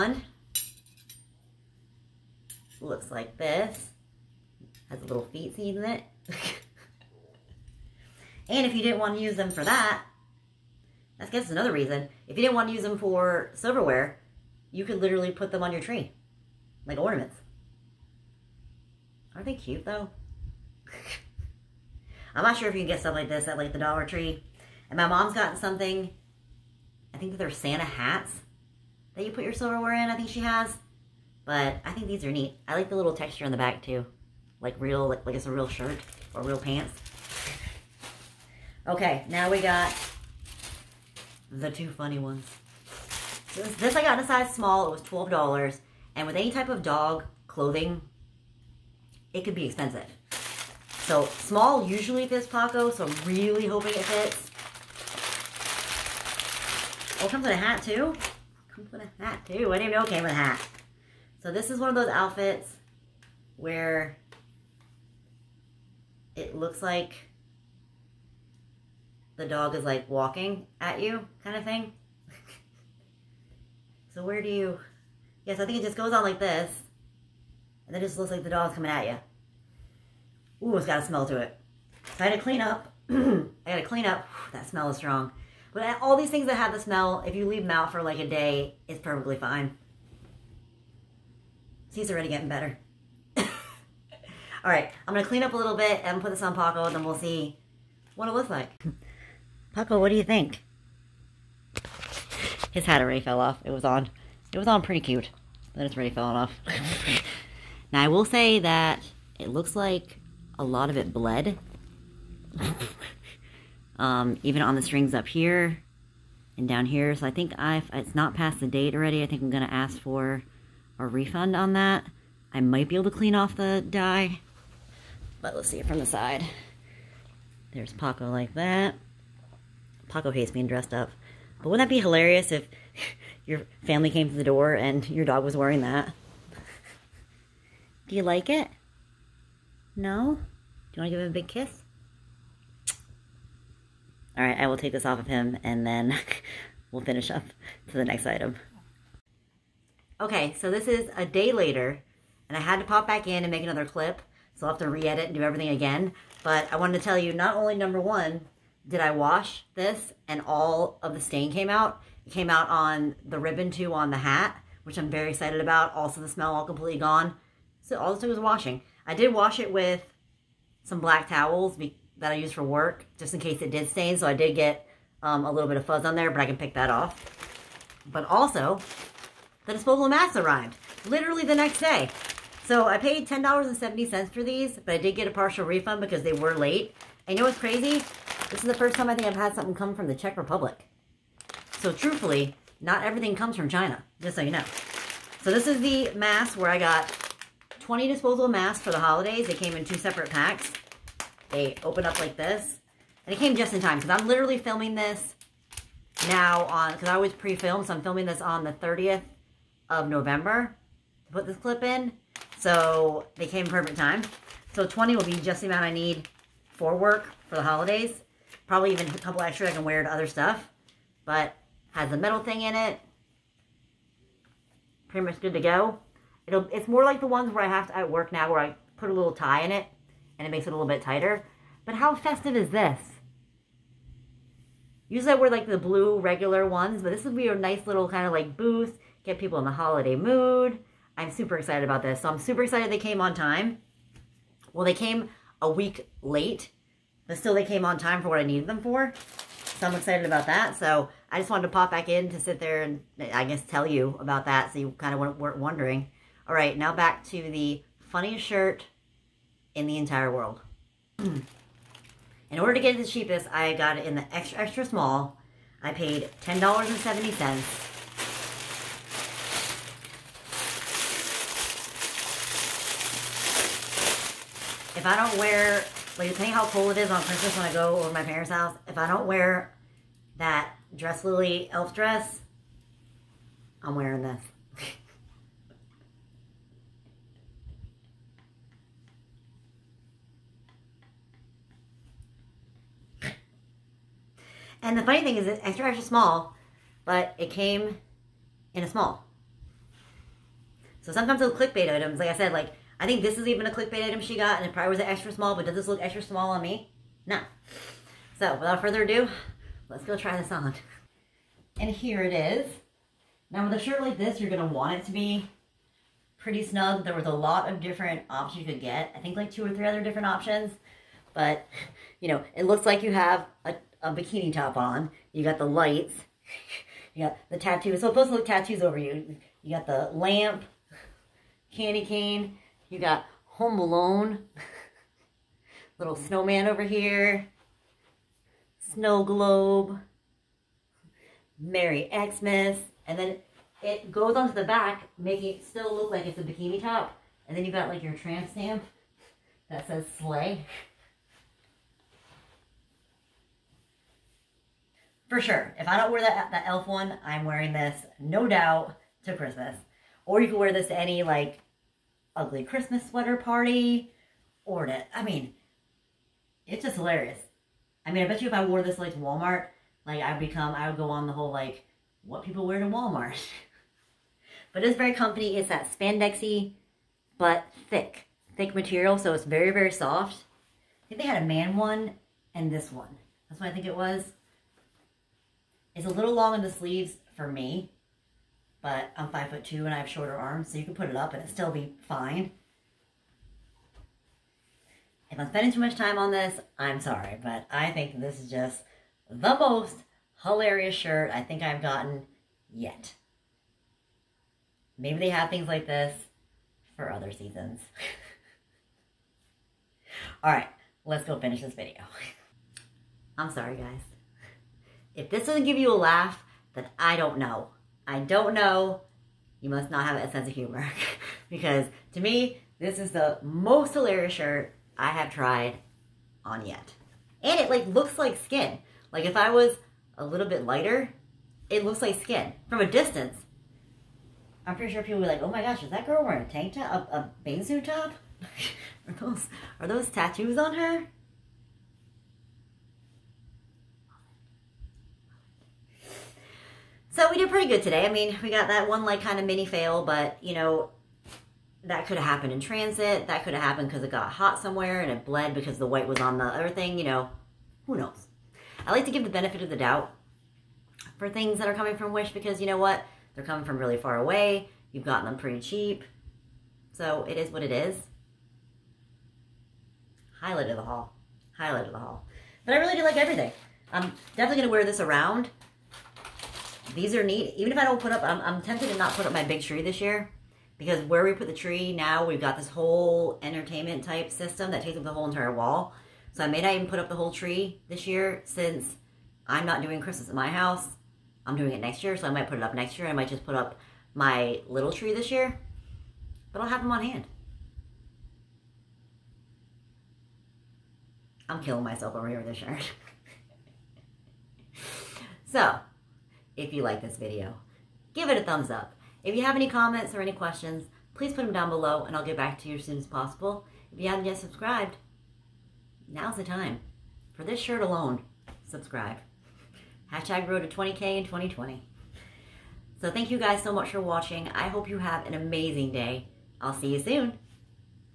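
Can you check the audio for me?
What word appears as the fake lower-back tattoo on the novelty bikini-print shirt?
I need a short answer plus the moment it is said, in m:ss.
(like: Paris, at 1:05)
Sleigh, at 5:50.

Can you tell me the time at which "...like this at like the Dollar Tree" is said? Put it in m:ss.
0:23.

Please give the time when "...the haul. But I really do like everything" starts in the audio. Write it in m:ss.
7:51.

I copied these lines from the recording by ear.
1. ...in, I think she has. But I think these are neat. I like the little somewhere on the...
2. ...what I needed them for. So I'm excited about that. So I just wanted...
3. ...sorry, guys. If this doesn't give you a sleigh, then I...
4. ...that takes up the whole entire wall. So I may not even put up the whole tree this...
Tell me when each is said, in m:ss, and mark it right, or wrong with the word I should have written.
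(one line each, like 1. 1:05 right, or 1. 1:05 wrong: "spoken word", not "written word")
1. 0:29 wrong: "texture", not "somewhere"
2. 4:08 right
3. 6:53 wrong: "laugh", not "sleigh"
4. 8:04 right.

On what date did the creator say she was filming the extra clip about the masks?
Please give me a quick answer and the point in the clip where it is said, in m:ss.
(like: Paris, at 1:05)
30th of November, at 3:28.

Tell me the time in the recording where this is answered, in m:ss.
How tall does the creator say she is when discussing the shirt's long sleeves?
6:29.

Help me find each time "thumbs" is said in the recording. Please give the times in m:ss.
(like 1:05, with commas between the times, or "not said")
8:28.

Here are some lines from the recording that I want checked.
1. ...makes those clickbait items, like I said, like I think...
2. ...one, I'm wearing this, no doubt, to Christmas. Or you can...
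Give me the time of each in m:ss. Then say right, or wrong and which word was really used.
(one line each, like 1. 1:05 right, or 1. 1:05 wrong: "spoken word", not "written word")
1. 5:01 wrong: "sometimes", not "makes"
2. 5:56 right.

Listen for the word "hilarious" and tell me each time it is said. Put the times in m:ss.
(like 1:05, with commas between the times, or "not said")
2:12, 6:06, 6:40, 7:03.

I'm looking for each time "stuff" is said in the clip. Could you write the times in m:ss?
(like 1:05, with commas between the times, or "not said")
0:23, 3:40.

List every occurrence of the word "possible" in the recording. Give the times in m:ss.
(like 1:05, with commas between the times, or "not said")
8:33.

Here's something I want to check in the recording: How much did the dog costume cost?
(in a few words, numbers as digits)
$12.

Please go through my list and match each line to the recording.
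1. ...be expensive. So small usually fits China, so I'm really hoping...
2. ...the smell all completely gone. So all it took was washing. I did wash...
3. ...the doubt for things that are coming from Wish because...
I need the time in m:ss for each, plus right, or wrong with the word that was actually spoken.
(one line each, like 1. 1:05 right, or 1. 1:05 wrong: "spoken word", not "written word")
1. 0:49 wrong: "Paco", not "China"
2. 2:46 right
3. 7:39 right.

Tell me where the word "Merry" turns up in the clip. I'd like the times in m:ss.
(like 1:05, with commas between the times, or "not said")
5:41.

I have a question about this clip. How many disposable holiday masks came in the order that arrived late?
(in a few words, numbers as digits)
20.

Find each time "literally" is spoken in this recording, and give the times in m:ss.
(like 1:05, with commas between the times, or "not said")
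0:15, 3:01, 3:24.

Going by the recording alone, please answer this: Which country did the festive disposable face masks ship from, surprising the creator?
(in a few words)
Czech Republic.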